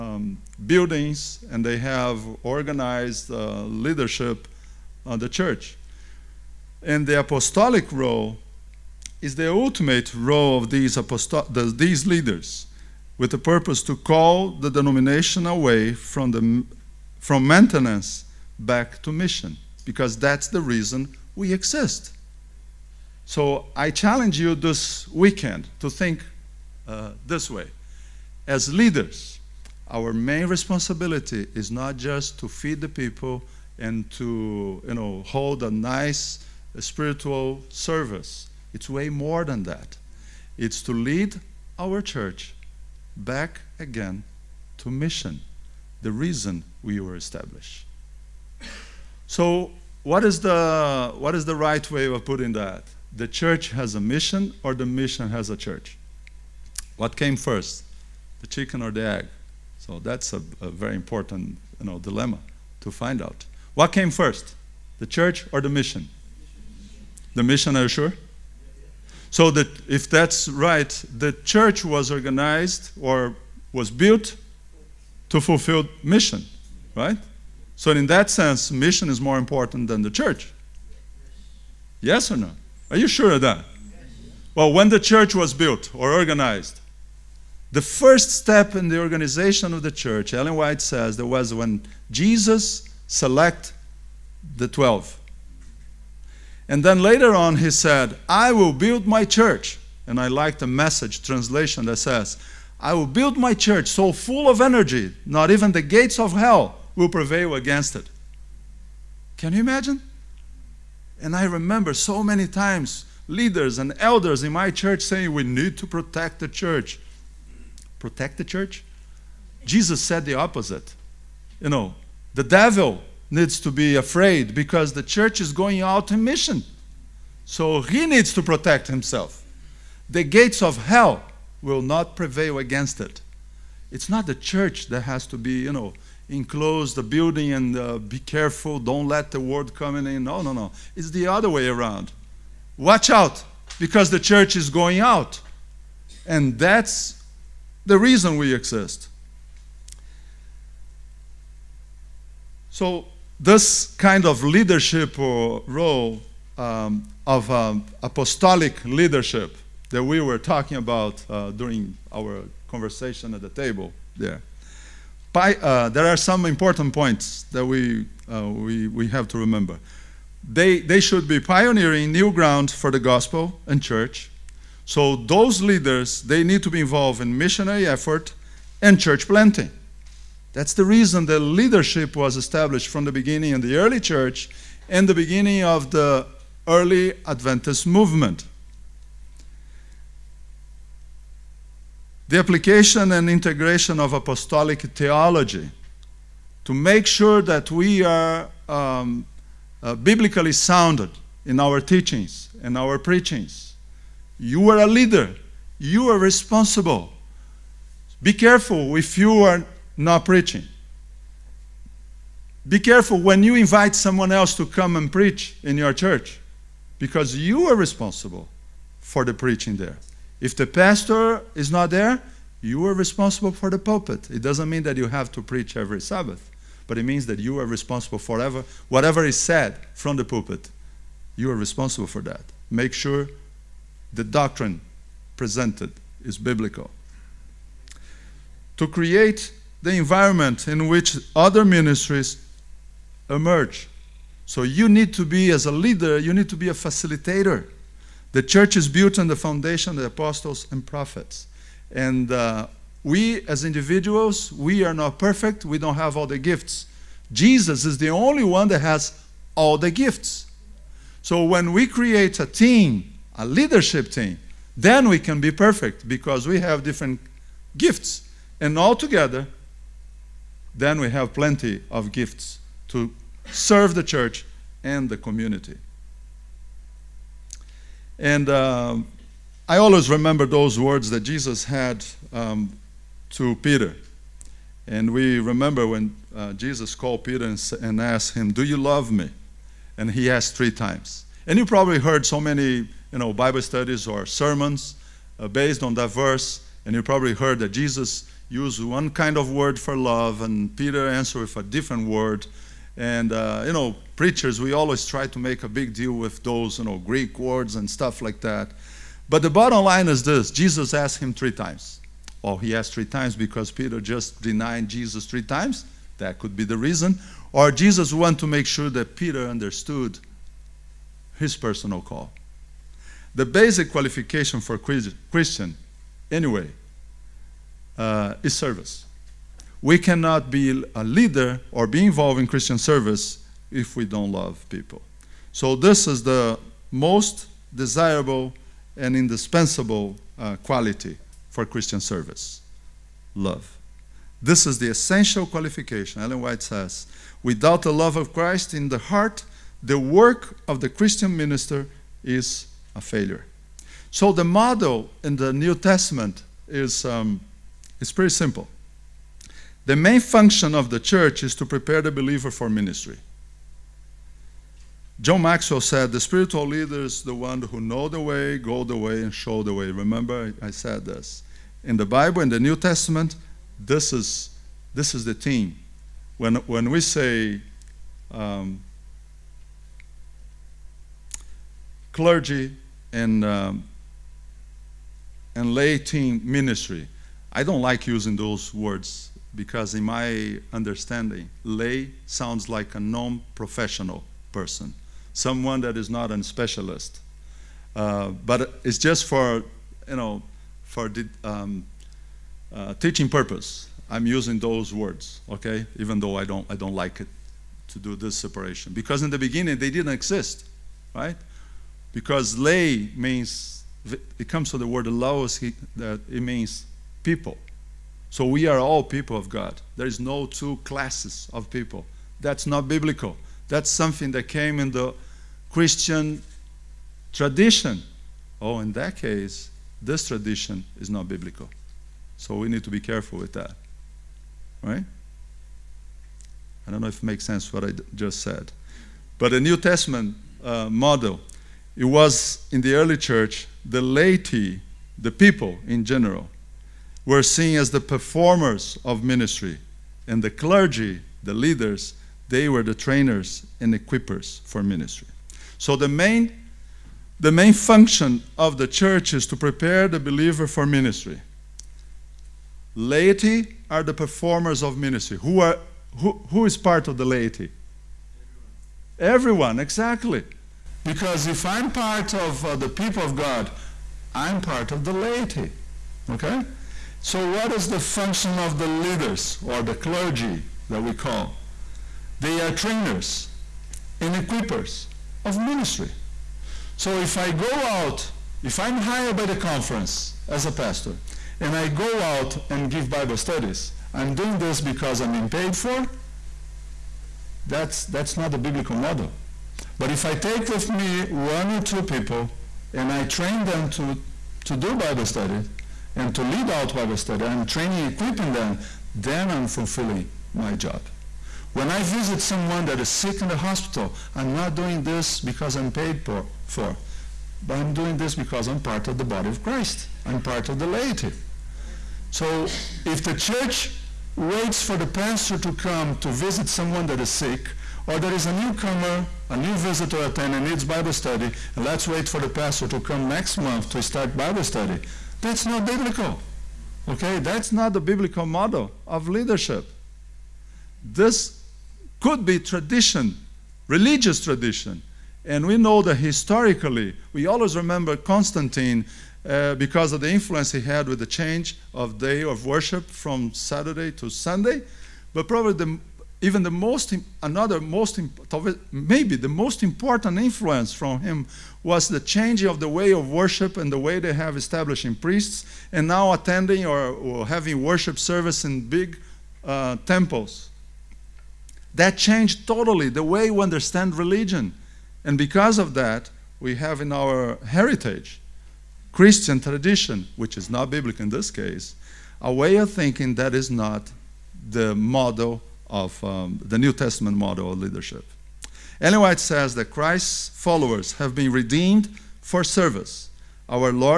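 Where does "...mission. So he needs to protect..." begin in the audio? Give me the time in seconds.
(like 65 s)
126 s.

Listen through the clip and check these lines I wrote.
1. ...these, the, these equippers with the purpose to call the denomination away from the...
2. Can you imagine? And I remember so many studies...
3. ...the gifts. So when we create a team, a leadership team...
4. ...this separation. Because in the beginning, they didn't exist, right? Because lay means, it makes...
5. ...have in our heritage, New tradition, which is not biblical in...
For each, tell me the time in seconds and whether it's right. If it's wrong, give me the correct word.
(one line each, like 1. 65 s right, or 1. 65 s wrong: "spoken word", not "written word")
1. 10 s wrong: "leaders", not "equippers"
2. 109 s wrong: "times", not "studies"
3. 259 s right
4. 408 s wrong: "comes", not "makes"
5. 576 s wrong: "Christian", not "New".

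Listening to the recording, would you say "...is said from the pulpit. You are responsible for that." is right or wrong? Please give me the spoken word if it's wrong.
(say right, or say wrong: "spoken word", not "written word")
right.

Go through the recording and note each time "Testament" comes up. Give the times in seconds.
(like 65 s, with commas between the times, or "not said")
355 s, 372 s, 439 s, 586 s.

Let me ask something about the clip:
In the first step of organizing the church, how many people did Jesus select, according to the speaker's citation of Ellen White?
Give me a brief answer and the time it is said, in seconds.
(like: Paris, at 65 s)
12, at 94 s.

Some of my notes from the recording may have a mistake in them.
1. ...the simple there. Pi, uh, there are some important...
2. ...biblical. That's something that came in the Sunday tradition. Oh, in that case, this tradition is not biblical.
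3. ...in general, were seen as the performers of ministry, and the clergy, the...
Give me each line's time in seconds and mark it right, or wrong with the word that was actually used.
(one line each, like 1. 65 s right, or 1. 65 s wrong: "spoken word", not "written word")
1. 163 s wrong: "table", not "simple"
2. 422 s wrong: "Christian", not "Sunday"
3. 445 s right.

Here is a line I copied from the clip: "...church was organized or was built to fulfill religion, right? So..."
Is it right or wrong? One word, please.
wrong.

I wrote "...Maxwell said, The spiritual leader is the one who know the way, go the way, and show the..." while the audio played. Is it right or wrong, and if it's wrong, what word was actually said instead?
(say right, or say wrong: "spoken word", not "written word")
right.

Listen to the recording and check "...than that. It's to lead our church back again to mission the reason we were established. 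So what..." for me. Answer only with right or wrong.
right.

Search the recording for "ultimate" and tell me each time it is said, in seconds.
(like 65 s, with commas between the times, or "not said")
9 s.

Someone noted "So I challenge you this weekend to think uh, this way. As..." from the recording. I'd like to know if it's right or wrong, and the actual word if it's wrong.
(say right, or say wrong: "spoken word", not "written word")
right.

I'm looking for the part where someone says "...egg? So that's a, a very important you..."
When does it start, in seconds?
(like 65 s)
59 s.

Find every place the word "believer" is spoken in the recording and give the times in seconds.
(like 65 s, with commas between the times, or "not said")
362 s, 460 s.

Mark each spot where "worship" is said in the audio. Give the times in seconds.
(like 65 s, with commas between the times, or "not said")
552 s, 563 s, 567 s.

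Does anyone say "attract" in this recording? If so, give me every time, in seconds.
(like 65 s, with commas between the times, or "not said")
not said.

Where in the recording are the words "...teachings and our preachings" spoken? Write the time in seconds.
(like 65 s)
201 s.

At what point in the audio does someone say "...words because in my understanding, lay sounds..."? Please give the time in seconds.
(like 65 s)
388 s.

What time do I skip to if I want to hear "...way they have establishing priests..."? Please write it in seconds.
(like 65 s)
563 s.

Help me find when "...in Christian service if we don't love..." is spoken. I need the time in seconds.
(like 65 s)
332 s.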